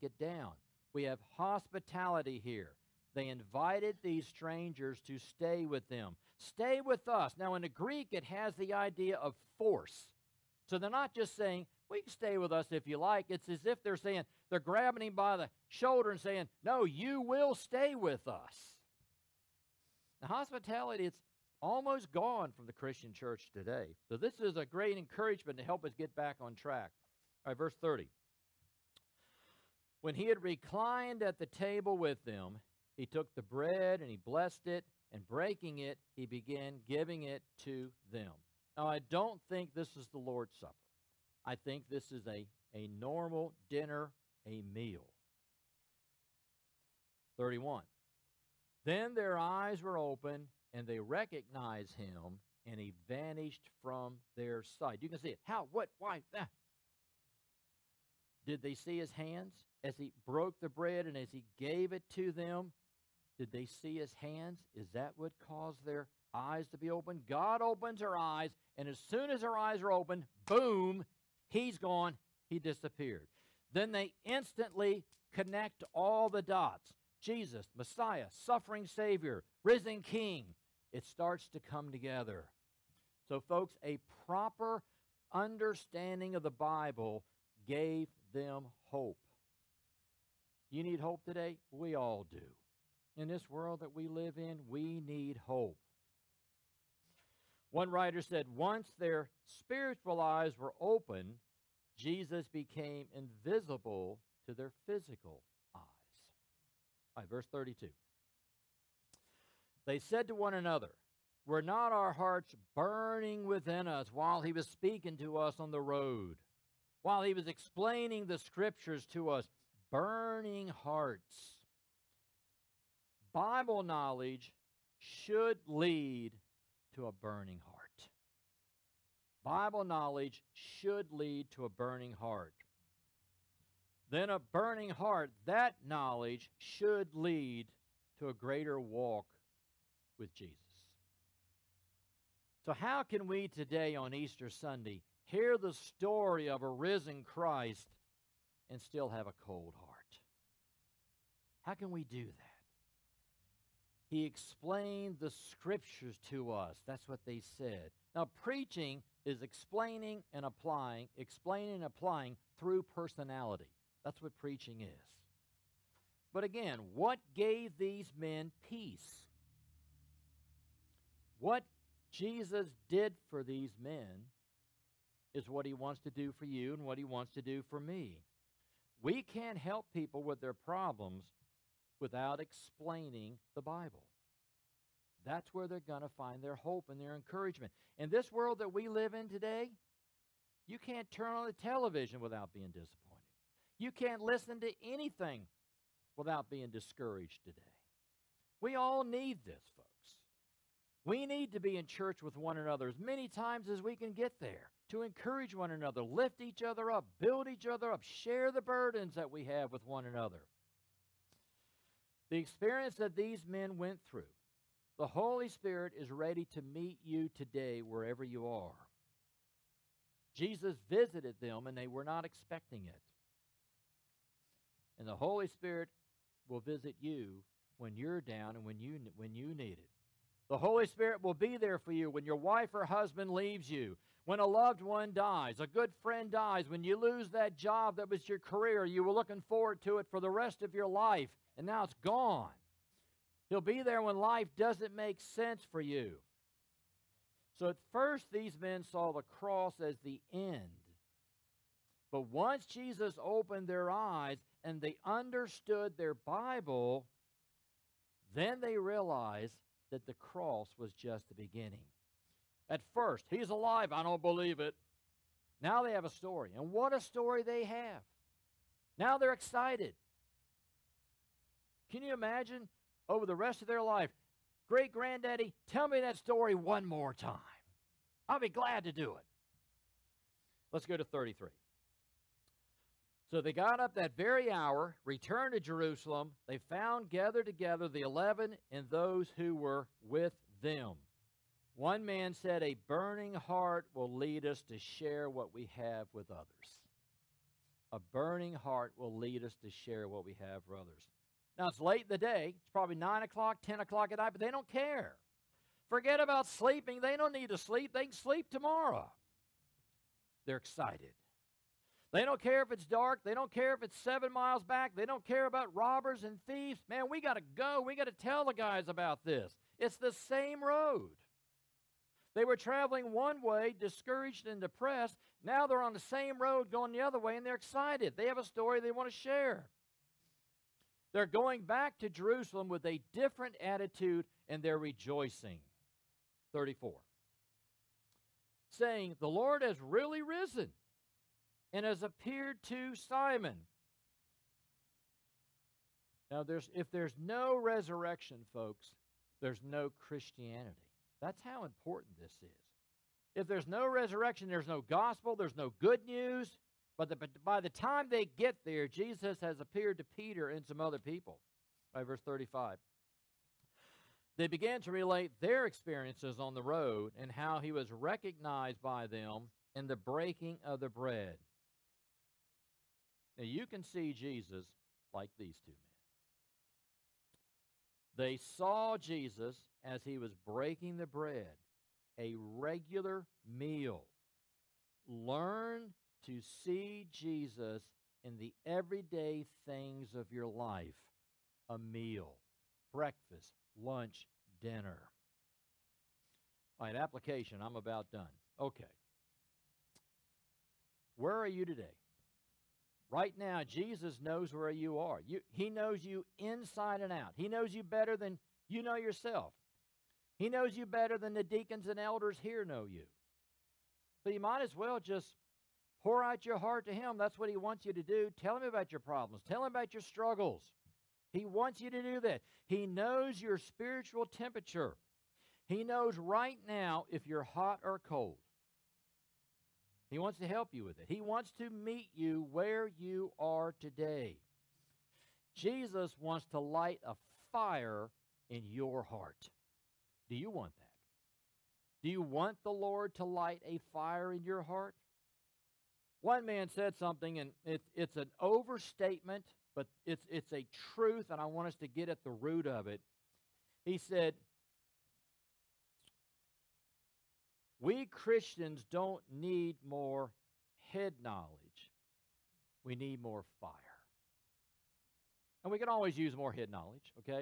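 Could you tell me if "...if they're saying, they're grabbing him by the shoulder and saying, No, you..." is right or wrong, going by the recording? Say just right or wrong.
right.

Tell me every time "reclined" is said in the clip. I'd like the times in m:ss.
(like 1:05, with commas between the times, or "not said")
0:30.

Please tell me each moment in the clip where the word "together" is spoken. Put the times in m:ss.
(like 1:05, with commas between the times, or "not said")
1:21, 4:47.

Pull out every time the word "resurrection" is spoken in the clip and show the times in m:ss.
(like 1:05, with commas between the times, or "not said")
5:47, 5:53.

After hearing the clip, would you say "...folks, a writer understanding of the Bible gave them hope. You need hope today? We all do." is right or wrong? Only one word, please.
wrong.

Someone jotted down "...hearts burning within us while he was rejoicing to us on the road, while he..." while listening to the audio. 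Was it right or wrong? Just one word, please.
wrong.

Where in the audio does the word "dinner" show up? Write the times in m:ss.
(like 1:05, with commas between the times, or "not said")
0:43, 6:34.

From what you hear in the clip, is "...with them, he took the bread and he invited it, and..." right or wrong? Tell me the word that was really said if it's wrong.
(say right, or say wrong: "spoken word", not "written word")
wrong: "blessed", not "invited".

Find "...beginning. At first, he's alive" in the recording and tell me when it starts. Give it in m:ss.
4:21.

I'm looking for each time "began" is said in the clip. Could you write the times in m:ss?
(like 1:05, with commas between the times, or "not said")
0:36, 6:04.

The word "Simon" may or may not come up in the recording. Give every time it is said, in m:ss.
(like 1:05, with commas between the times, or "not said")
5:42.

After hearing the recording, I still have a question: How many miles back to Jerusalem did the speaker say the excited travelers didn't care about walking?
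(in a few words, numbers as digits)
7.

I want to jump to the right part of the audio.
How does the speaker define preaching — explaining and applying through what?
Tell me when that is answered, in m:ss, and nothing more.
2:42.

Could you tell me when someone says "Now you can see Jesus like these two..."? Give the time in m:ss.
6:13.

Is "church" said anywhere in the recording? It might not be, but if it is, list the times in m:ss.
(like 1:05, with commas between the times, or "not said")
0:23, 3:21.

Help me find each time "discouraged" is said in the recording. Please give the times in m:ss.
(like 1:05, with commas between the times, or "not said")
3:16, 5:23.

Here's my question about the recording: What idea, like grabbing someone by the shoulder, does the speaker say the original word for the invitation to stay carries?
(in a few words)
Force.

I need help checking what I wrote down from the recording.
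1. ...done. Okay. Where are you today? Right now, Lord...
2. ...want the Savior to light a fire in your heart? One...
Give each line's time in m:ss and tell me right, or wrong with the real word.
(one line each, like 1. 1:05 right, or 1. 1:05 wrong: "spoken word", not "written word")
1. 6:38 wrong: "Jesus", not "Lord"
2. 7:22 wrong: "Lord", not "Savior".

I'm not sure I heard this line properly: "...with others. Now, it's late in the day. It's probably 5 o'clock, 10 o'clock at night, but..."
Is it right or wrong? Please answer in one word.
wrong.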